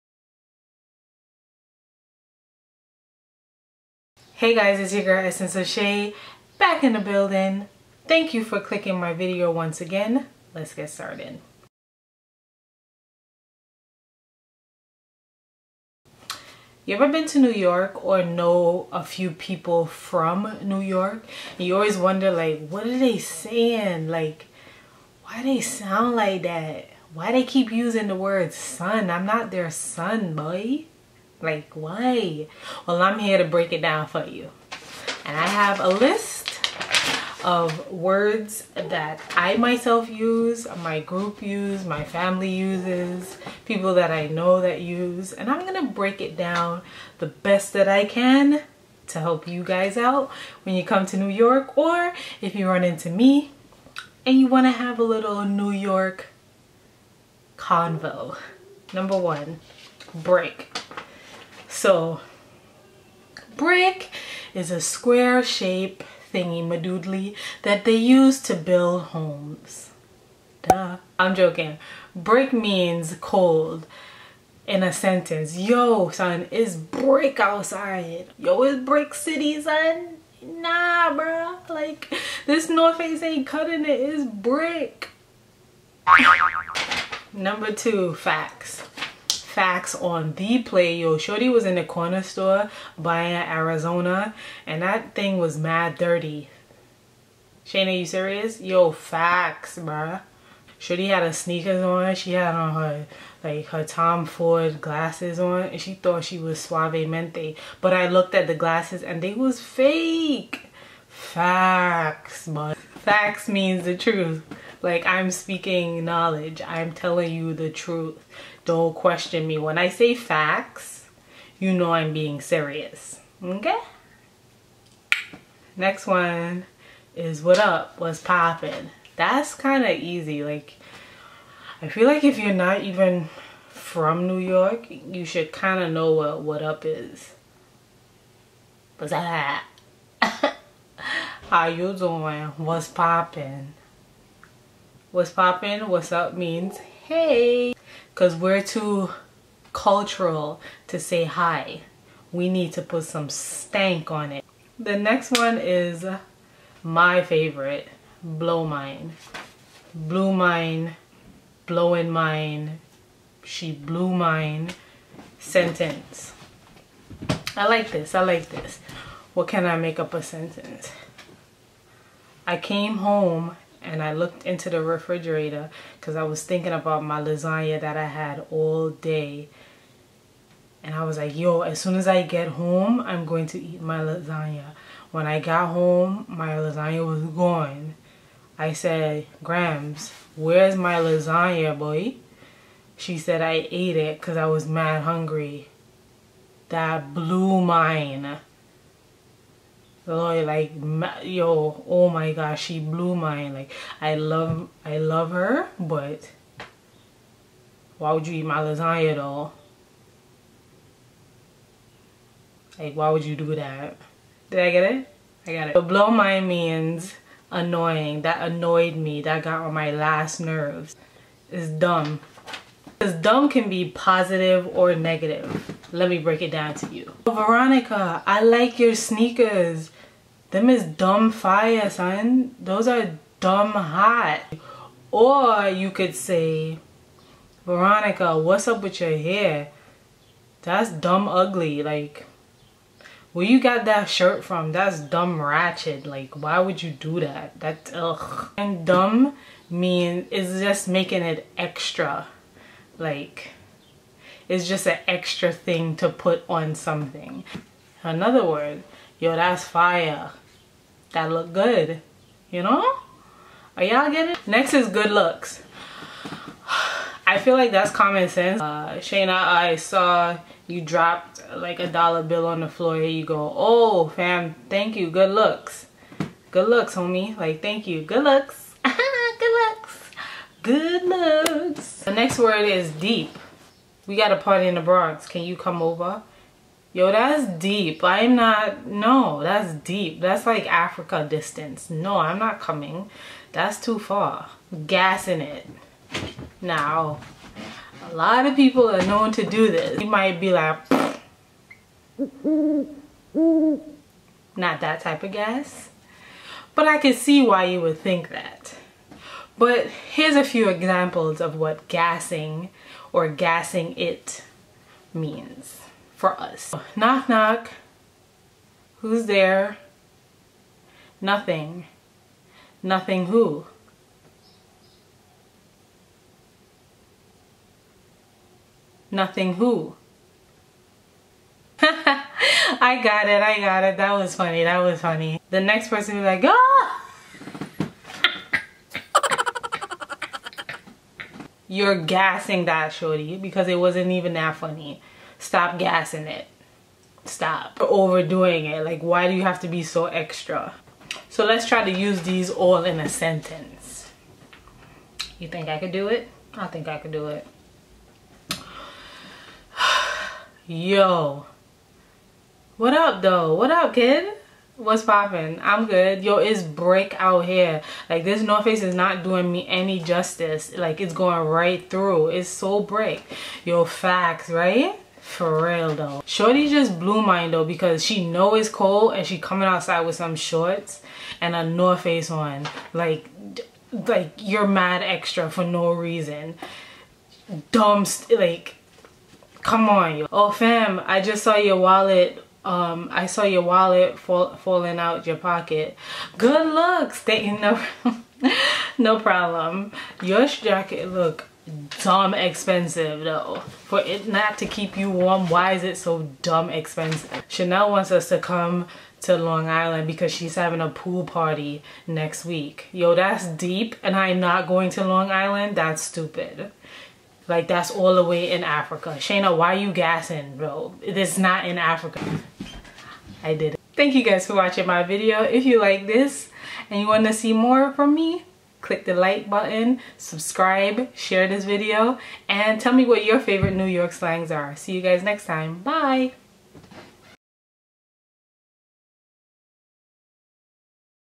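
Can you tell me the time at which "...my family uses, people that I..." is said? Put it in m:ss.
0:41.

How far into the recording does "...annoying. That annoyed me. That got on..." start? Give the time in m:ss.
3:37.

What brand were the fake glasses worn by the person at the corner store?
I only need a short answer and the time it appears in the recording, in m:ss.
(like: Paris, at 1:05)
Tom Ford, at 1:43.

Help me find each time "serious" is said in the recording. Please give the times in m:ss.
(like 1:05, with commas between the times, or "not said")
1:38, 2:02.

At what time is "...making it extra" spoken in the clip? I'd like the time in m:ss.
4:10.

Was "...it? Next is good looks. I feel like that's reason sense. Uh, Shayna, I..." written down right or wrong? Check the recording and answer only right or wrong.
wrong.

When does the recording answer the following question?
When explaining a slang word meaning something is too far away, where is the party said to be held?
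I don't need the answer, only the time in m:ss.
4:44.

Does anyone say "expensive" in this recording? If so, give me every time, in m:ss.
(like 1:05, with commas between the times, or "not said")
6:42, 6:46.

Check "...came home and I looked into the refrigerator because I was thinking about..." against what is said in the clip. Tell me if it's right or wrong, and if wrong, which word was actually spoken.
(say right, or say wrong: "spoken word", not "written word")
right.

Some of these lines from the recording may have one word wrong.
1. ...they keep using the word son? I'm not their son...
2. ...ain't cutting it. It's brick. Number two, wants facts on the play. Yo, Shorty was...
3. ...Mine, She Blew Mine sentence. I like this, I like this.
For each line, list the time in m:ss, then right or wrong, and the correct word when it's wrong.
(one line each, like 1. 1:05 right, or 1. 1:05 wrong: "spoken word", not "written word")
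1. 0:27 right
2. 1:23 wrong: "facts", not "wants"
3. 2:42 right.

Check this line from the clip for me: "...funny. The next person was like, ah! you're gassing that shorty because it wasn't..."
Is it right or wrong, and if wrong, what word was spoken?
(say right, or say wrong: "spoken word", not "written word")
right.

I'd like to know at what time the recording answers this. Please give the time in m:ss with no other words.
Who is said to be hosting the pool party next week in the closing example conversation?
6:47.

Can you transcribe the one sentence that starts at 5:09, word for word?
But here's a few examples of what gassing or gassing it means for us.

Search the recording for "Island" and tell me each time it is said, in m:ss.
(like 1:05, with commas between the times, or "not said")
6:49, 6:55.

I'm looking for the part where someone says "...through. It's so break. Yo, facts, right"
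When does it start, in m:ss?
6:11.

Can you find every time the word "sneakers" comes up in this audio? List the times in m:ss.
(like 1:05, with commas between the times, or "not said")
1:41, 3:48.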